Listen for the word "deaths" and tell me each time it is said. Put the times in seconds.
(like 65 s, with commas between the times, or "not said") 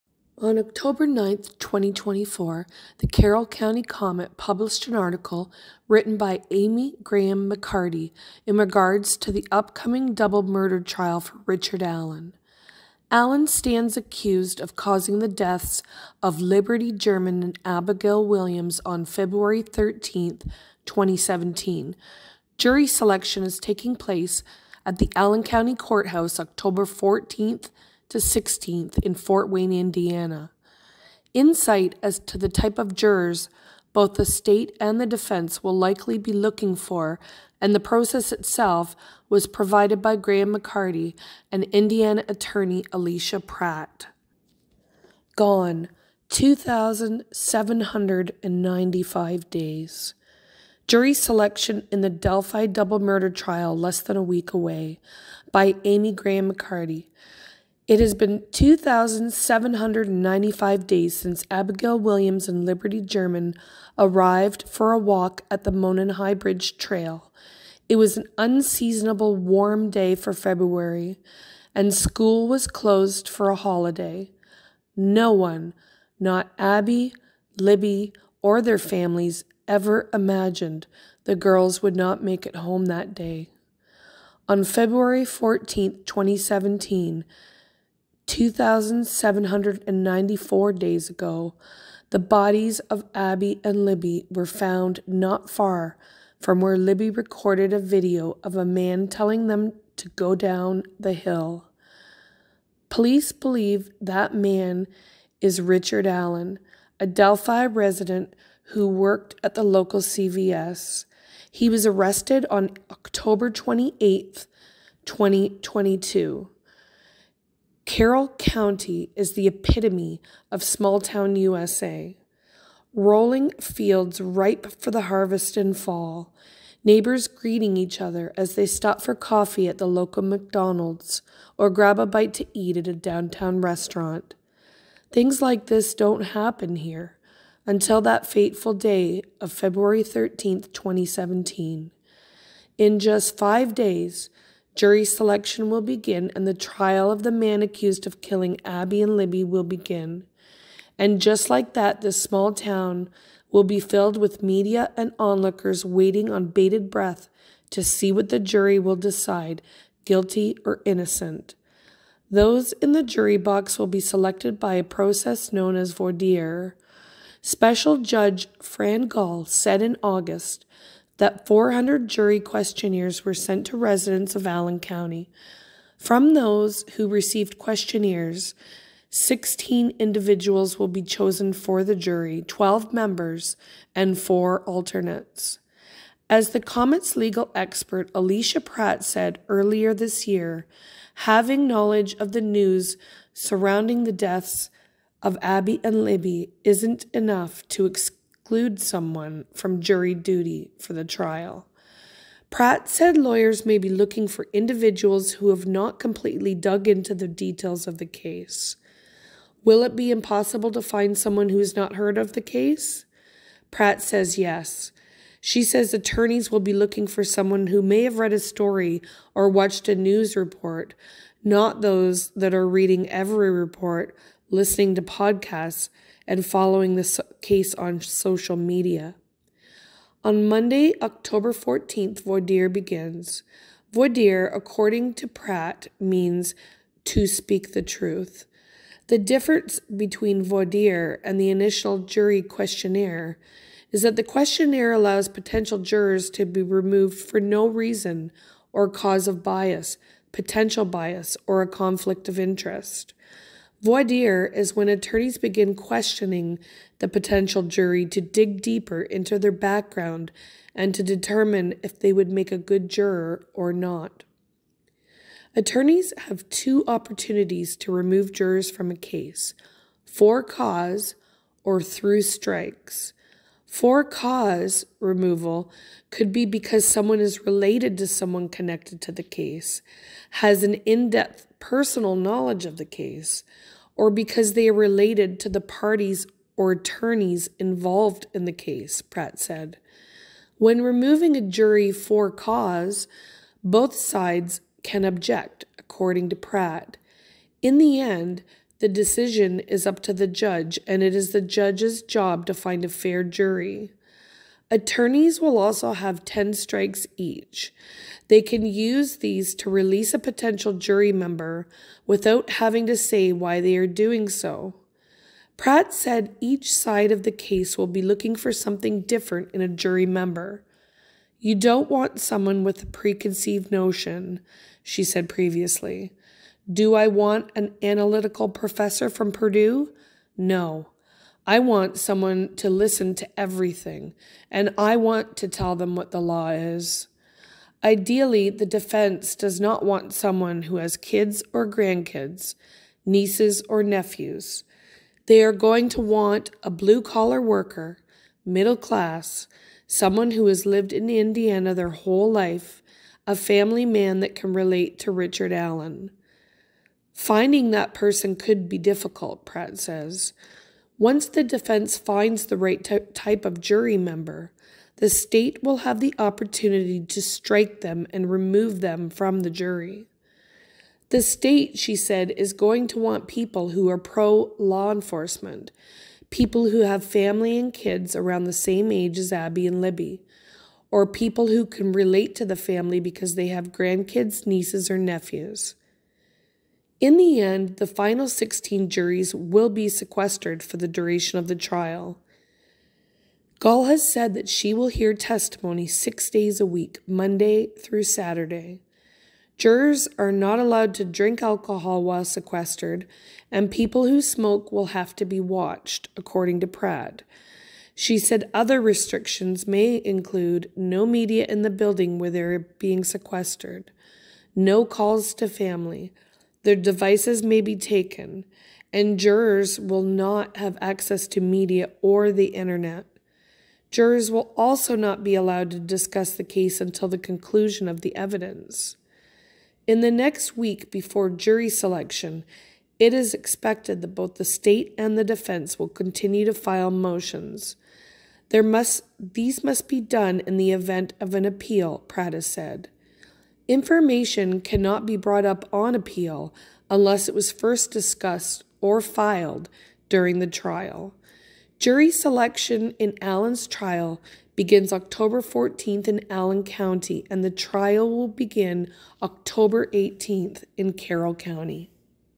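15 s, 194 s.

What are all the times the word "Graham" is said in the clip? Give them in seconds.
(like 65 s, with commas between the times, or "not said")
7 s, 40 s, 56 s.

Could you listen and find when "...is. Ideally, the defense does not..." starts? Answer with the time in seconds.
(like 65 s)
336 s.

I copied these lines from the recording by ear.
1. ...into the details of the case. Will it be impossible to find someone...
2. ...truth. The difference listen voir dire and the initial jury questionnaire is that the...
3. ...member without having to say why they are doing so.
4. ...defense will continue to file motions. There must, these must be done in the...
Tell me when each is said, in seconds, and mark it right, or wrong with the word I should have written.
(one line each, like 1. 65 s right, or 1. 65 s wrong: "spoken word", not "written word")
1. 206 s right
2. 237 s wrong: "between", not "listen"
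3. 311 s right
4. 435 s right.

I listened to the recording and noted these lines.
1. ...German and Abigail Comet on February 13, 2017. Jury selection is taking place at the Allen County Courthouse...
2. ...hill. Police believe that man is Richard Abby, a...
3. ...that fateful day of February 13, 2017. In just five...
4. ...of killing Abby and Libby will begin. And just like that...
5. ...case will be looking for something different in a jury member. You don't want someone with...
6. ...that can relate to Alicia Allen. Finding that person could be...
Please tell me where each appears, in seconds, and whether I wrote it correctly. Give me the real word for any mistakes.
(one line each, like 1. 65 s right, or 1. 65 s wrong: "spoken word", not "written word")
1. 16 s wrong: "Williams", not "Comet"
2. 101 s wrong: "Allen", not "Abby"
3. 137 s right
4. 148 s right
5. 317 s right
6. 354 s wrong: "Richard", not "Alicia".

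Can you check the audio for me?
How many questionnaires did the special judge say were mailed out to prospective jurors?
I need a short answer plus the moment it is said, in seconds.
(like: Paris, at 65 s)
400, at 171 s.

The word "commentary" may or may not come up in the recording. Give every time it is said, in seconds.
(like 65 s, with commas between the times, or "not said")
not said.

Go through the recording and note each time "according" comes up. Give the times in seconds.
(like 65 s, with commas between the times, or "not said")
234 s, 295 s, 406 s.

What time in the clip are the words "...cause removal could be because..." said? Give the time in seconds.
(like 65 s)
274 s.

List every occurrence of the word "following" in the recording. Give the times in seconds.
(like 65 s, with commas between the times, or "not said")
226 s.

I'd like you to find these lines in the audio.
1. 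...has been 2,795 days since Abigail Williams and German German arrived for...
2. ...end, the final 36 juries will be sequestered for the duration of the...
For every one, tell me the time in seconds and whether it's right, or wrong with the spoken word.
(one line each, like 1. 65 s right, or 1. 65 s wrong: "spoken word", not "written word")
1. 57 s wrong: "Liberty", not "German"
2. 387 s wrong: "16", not "36".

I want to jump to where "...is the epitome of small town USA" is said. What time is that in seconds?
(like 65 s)
119 s.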